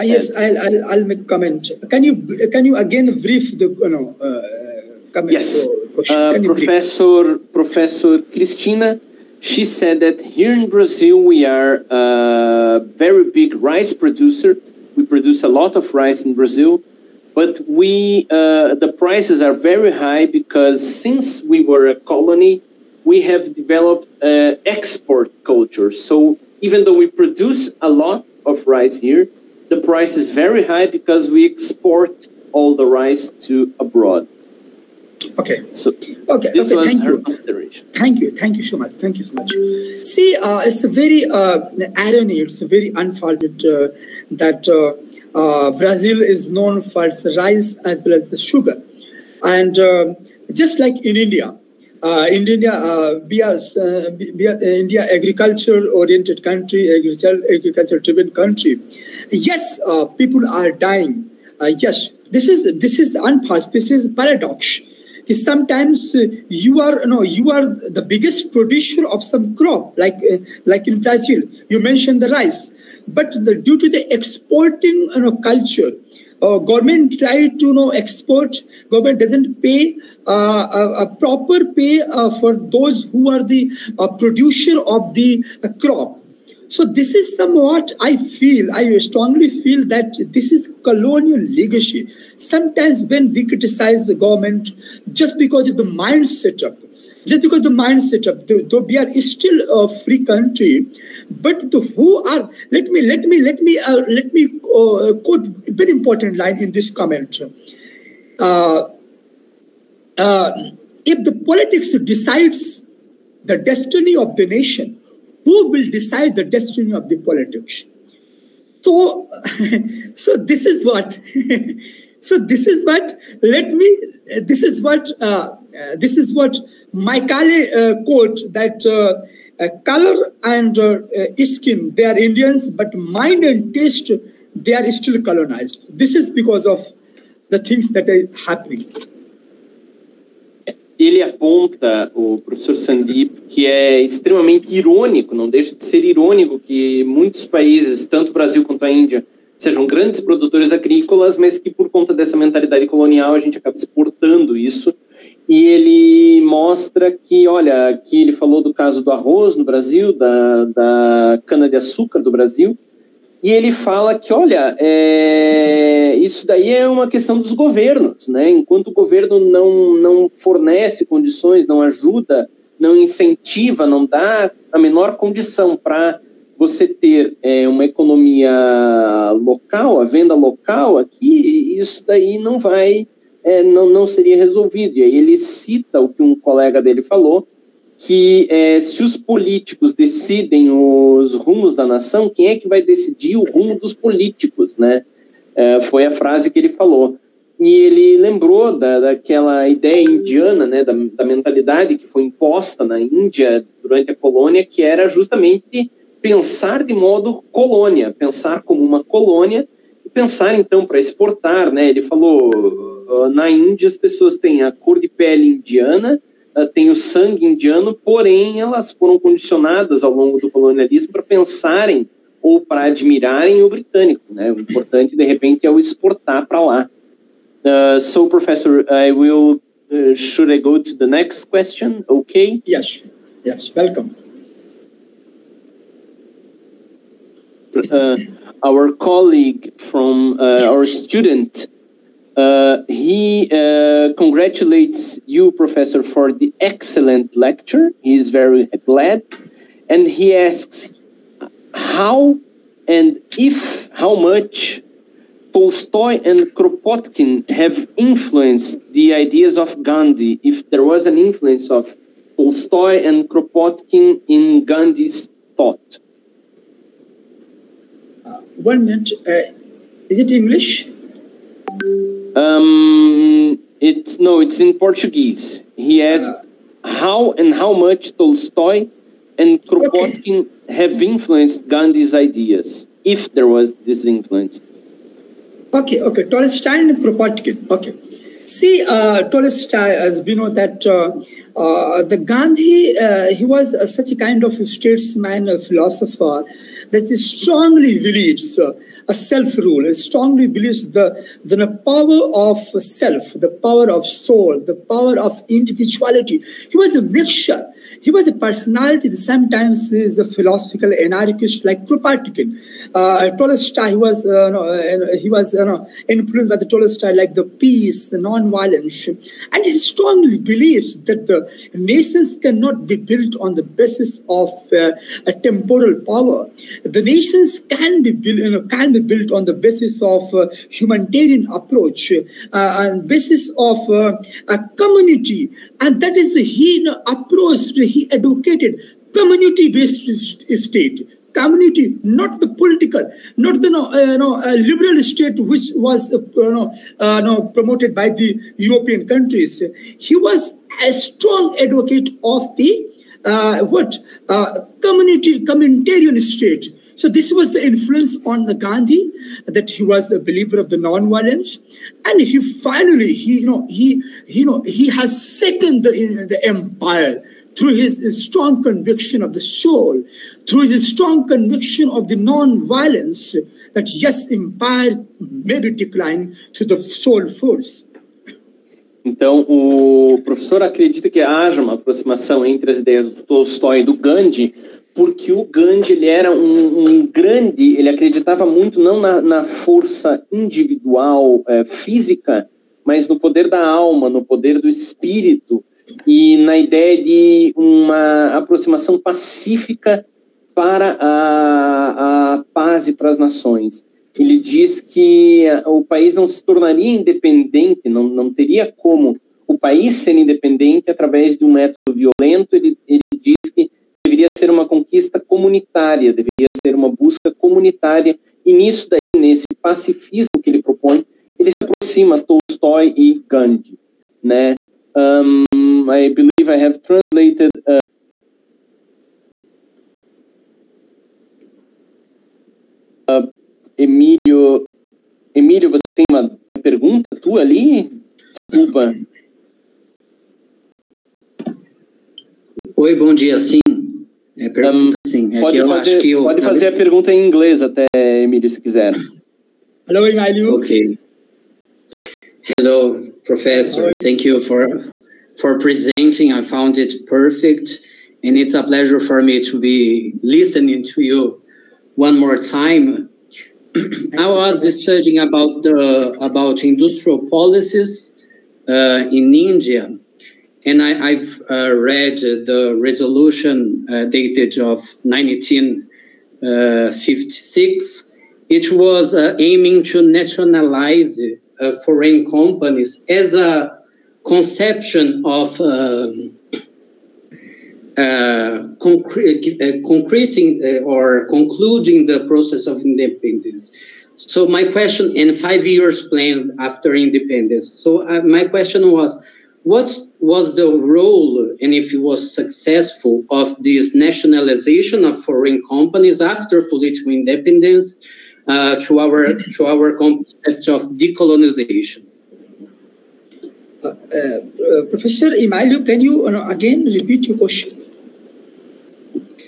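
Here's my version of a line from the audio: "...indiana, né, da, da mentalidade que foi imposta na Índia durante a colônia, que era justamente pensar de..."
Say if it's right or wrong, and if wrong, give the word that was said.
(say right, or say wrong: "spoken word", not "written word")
right.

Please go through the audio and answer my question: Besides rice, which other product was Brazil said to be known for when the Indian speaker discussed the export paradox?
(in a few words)
Sugar.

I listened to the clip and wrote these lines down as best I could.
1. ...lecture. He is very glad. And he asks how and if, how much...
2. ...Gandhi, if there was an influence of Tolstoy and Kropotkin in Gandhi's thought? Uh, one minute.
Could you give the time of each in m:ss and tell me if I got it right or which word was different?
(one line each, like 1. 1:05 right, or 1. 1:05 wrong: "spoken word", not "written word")
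1. 4:07 right
2. 4:19 right.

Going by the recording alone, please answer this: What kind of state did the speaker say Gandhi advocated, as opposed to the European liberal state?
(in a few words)
Communitarian state.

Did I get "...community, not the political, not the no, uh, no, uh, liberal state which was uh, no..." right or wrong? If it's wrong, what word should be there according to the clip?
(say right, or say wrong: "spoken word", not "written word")
right.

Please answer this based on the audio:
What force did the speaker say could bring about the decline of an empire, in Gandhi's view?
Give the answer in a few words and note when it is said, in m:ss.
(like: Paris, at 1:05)
Soul force, at 6:16.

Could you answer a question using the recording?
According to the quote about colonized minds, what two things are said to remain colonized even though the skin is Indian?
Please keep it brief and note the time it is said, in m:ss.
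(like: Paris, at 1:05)
Mind and taste, at 2:13.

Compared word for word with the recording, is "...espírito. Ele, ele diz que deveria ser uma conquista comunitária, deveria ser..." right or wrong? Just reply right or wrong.
wrong.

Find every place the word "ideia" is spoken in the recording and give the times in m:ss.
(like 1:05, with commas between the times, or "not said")
3:19, 6:22, 6:36.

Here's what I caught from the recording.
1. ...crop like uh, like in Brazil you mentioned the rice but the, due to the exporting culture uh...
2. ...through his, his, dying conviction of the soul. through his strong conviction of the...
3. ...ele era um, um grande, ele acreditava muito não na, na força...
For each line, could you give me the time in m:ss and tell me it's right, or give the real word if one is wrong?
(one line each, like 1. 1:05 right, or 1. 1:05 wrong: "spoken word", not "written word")
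1. 1:09 right
2. 6:07 wrong: "strong", not "dying"
3. 6:25 right.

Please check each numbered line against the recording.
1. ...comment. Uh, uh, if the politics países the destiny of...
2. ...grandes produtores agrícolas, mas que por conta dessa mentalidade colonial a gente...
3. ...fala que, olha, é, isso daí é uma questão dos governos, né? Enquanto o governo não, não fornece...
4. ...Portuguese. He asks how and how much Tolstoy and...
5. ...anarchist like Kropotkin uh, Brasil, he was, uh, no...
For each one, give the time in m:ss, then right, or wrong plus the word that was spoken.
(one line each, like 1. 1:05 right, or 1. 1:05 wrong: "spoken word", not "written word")
1. 1:46 wrong: "decides", not "países"
2. 2:29 right
3. 2:43 right
4. 4:34 right
5. 5:11 wrong: "Tolstoy", not "Brasil".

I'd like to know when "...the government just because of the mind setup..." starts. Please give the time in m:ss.
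1:34.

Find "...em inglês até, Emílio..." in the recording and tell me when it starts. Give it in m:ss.
7:27.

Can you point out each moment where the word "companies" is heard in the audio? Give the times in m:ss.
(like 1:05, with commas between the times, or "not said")
8:02, 8:25.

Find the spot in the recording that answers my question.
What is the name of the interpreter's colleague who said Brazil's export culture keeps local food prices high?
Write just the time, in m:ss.
0:07.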